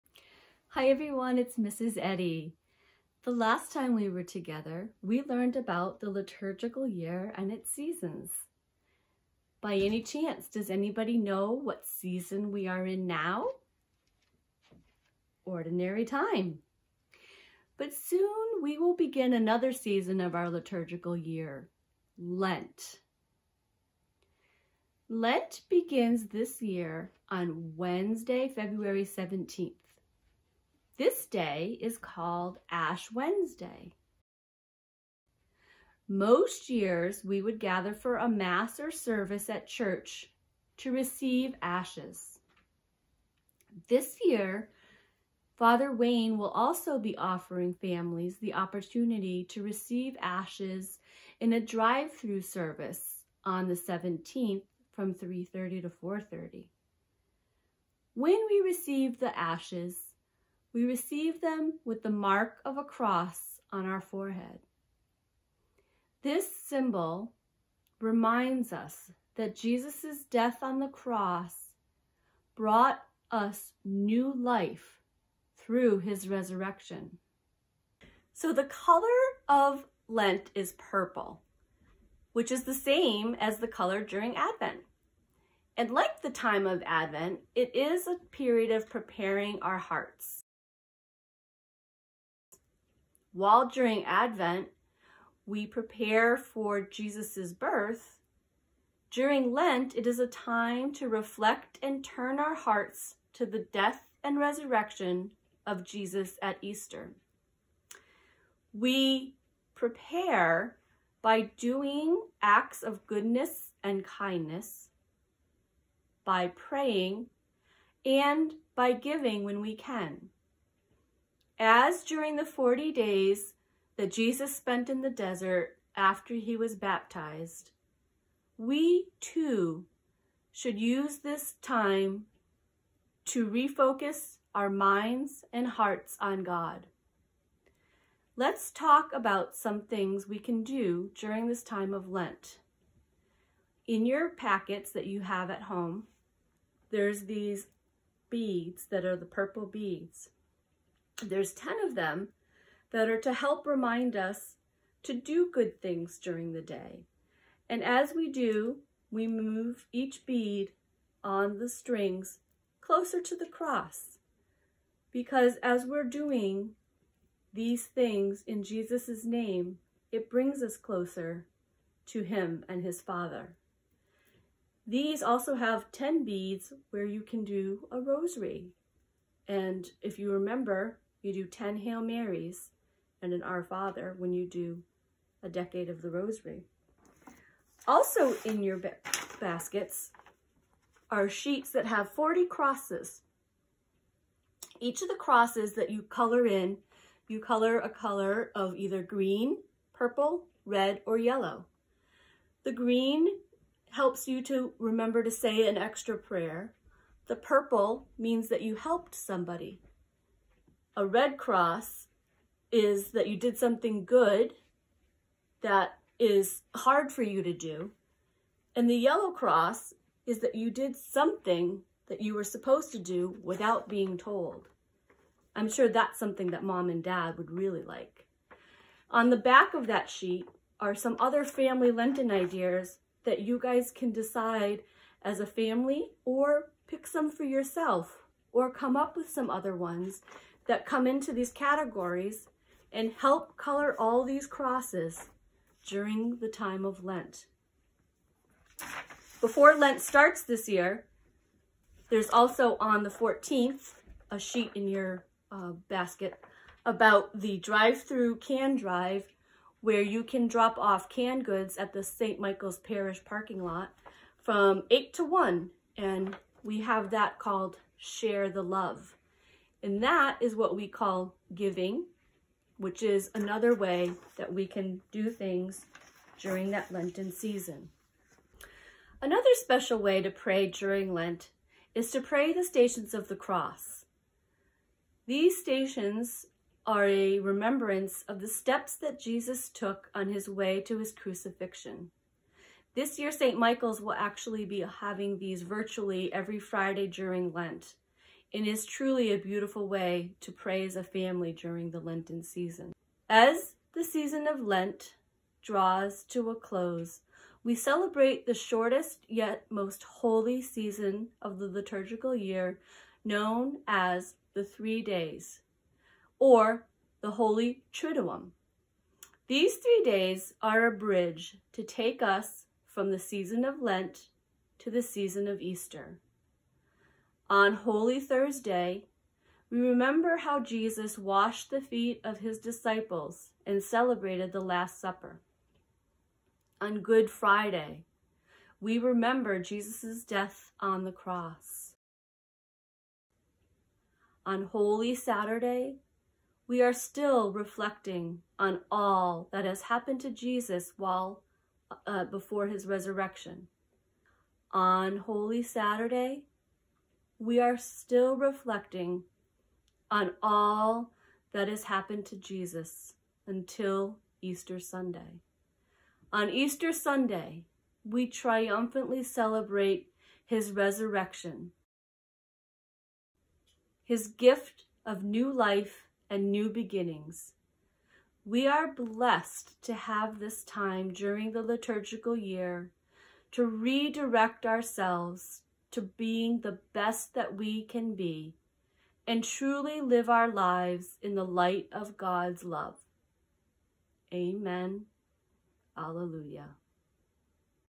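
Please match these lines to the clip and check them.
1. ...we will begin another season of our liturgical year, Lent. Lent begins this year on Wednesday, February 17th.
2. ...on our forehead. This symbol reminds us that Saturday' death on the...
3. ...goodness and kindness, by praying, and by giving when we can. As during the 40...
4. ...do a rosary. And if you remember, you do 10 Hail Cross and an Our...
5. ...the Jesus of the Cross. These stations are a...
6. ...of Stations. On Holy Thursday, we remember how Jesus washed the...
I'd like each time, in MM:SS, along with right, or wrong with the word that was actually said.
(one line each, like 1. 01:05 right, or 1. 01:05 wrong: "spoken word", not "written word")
1. 00:18 right
2. 01:03 wrong: "Jesus", not "Saturday"
3. 01:53 right
4. 02:57 wrong: "Marys", not "Cross"
5. 04:42 wrong: "Stations", not "Jesus"
6. 05:25 wrong: "Easter", not "Stations".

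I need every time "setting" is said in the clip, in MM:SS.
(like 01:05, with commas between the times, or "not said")
not said.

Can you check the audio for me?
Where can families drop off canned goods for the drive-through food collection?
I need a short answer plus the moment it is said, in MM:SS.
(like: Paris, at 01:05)
St. Michael's Parish parking lot, at 04:22.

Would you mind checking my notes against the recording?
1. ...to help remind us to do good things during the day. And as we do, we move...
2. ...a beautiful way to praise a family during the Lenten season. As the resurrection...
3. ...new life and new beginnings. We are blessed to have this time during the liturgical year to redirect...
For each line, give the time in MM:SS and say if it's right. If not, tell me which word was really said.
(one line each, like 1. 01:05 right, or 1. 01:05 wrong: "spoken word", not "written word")
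1. 02:33 right
2. 04:59 wrong: "season", not "resurrection"
3. 06:15 right.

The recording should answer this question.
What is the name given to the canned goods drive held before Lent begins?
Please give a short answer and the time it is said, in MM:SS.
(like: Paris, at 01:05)
Share the Love, at 04:27.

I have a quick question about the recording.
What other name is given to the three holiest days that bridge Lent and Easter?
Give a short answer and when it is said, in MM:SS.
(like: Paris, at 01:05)
Holy Triduum, at 05:17.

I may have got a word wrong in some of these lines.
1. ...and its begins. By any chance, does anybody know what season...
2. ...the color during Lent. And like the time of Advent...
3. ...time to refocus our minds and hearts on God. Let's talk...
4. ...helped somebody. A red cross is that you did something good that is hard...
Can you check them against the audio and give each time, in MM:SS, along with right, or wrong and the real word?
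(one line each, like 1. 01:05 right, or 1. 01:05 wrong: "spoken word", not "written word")
1. 00:07 wrong: "seasons", not "begins"
2. 01:23 wrong: "Advent", not "Lent"
3. 02:11 right
4. 03:28 right.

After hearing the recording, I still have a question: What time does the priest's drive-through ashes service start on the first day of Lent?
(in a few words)
3:30.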